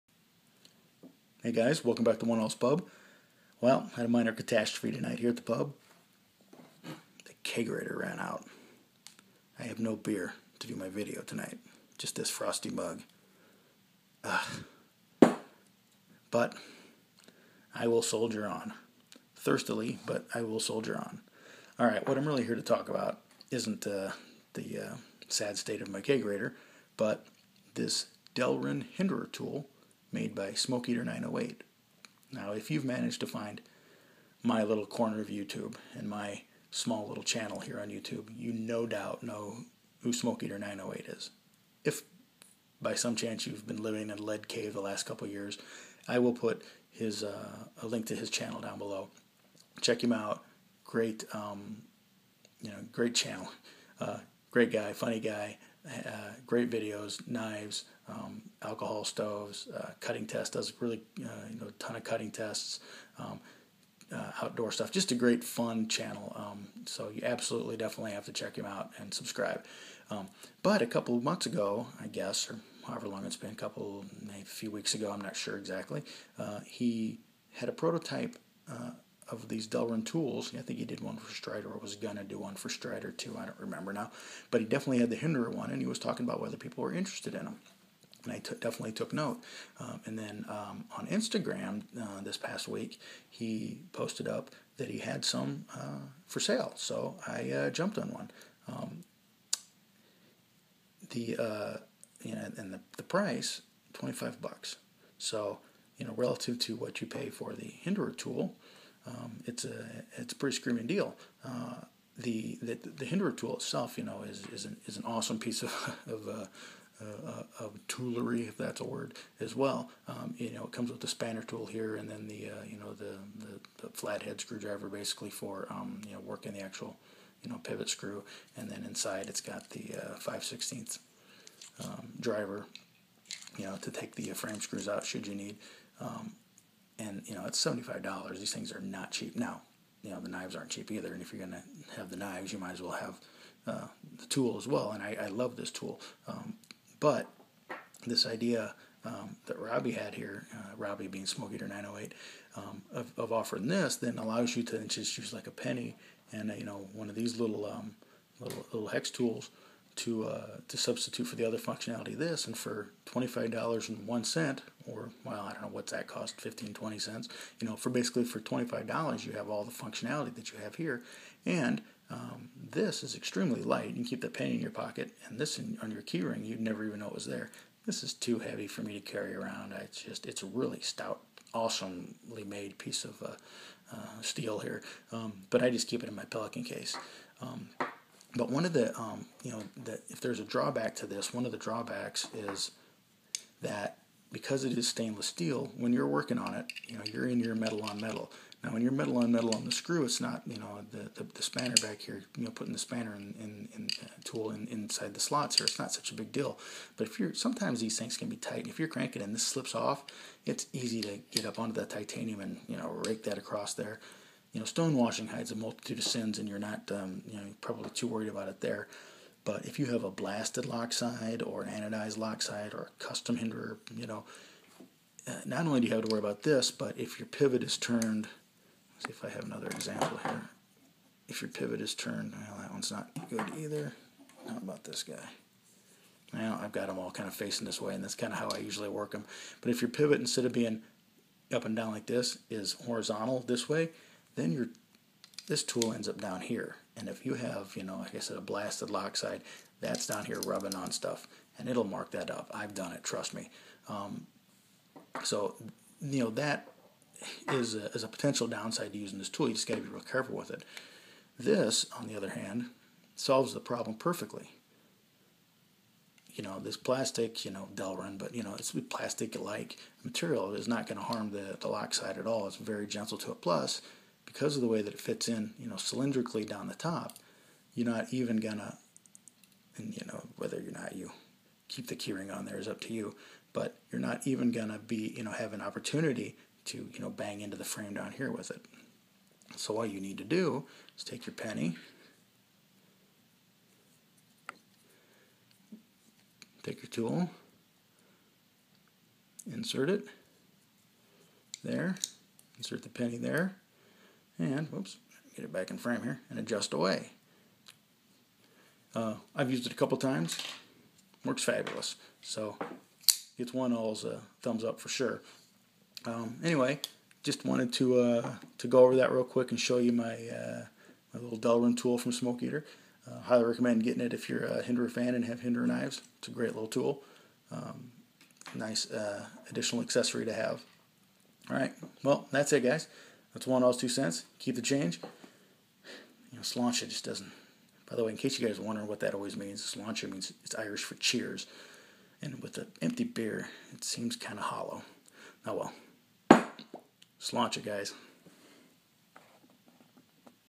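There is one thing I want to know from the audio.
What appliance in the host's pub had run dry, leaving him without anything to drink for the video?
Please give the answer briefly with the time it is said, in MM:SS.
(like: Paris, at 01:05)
The kegerator, at 00:07.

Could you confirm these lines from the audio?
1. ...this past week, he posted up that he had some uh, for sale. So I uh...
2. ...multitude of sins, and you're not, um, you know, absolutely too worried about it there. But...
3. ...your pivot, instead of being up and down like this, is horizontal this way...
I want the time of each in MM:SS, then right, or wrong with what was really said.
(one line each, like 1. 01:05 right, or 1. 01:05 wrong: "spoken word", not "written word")
1. 01:32 right
2. 03:35 wrong: "probably", not "absolutely"
3. 03:59 right.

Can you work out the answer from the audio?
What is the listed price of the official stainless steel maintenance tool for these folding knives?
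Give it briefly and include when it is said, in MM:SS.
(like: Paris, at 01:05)
$75, at 02:17.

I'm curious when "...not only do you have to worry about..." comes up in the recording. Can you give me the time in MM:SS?
03:45.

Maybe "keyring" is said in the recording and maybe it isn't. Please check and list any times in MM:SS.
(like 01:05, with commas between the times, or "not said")
02:56, 04:41.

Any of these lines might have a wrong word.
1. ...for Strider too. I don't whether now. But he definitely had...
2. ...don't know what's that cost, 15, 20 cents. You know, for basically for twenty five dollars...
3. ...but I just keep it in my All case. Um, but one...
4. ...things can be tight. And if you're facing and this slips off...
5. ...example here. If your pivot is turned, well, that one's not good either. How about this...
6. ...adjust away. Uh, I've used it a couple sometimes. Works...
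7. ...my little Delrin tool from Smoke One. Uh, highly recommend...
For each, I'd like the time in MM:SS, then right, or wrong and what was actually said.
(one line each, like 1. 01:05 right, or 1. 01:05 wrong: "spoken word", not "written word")
1. 01:22 wrong: "remember", not "whether"
2. 02:45 right
3. 03:05 wrong: "Pelican", not "All"
4. 03:27 wrong: "cranking", not "facing"
5. 03:49 right
6. 05:06 wrong: "times", not "sometimes"
7. 05:21 wrong: "Eater", not "One".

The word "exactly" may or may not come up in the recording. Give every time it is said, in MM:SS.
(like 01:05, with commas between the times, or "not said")
01:15.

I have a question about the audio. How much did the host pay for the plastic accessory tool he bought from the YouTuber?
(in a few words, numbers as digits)
$25.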